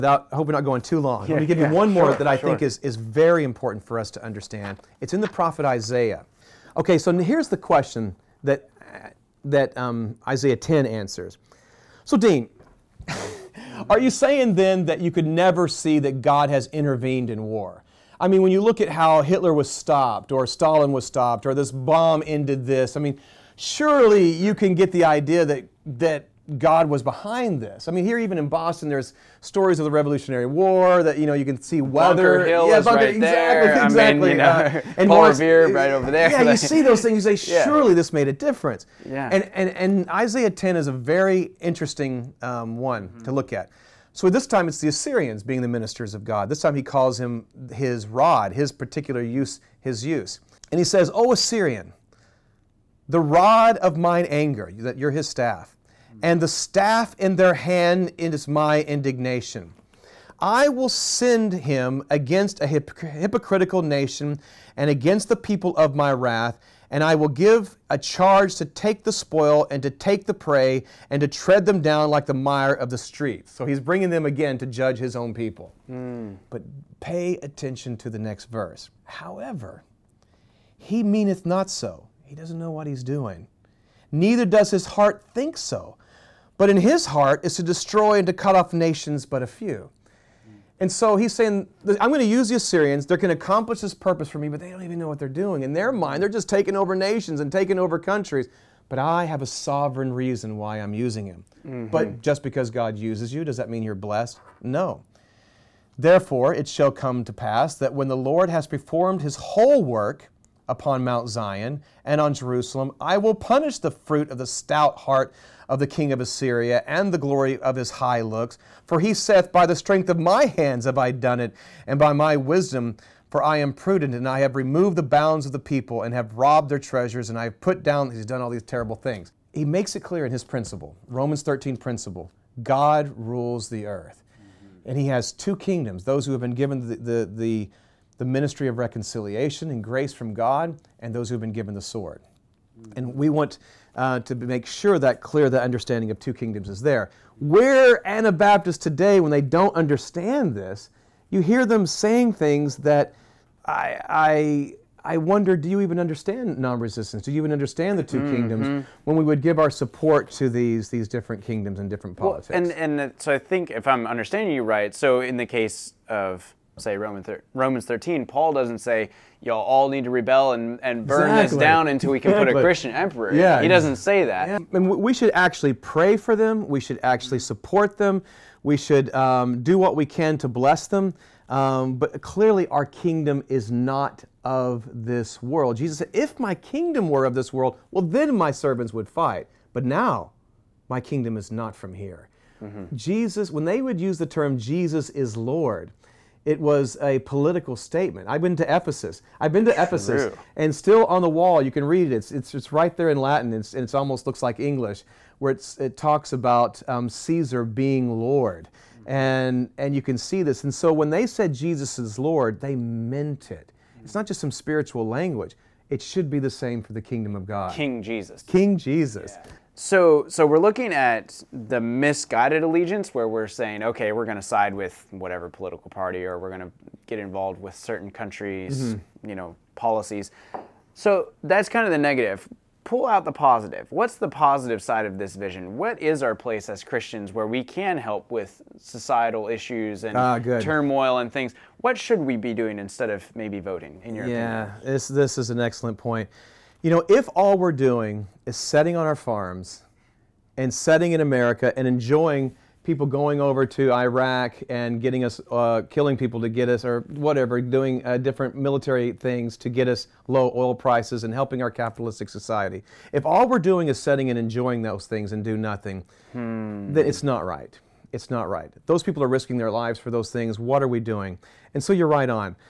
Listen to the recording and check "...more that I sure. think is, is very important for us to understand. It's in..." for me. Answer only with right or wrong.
right.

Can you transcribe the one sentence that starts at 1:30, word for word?
And so he's saying, I'm going to use the Assyrians.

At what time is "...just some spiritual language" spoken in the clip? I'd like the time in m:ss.
3:34.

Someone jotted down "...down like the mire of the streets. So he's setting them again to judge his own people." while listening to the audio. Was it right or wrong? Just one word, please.
wrong.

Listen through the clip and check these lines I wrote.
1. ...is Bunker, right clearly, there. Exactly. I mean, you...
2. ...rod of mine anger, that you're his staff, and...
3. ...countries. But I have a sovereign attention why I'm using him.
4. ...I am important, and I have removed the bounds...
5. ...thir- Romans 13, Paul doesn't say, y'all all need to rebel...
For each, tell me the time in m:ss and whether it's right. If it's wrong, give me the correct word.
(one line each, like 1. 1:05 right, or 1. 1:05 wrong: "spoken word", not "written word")
1. 0:32 wrong: "exactly", not "clearly"
2. 0:53 right
3. 1:37 wrong: "reason", not "attention"
4. 2:03 wrong: "prudent", not "important"
5. 2:47 right.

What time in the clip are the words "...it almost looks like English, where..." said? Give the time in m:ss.
3:23.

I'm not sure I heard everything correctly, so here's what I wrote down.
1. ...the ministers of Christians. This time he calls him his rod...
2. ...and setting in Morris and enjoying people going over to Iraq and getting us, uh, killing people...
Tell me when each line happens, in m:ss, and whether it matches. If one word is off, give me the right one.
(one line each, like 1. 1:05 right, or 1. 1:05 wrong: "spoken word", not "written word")
1. 0:45 wrong: "God", not "Christians"
2. 4:10 wrong: "America", not "Morris".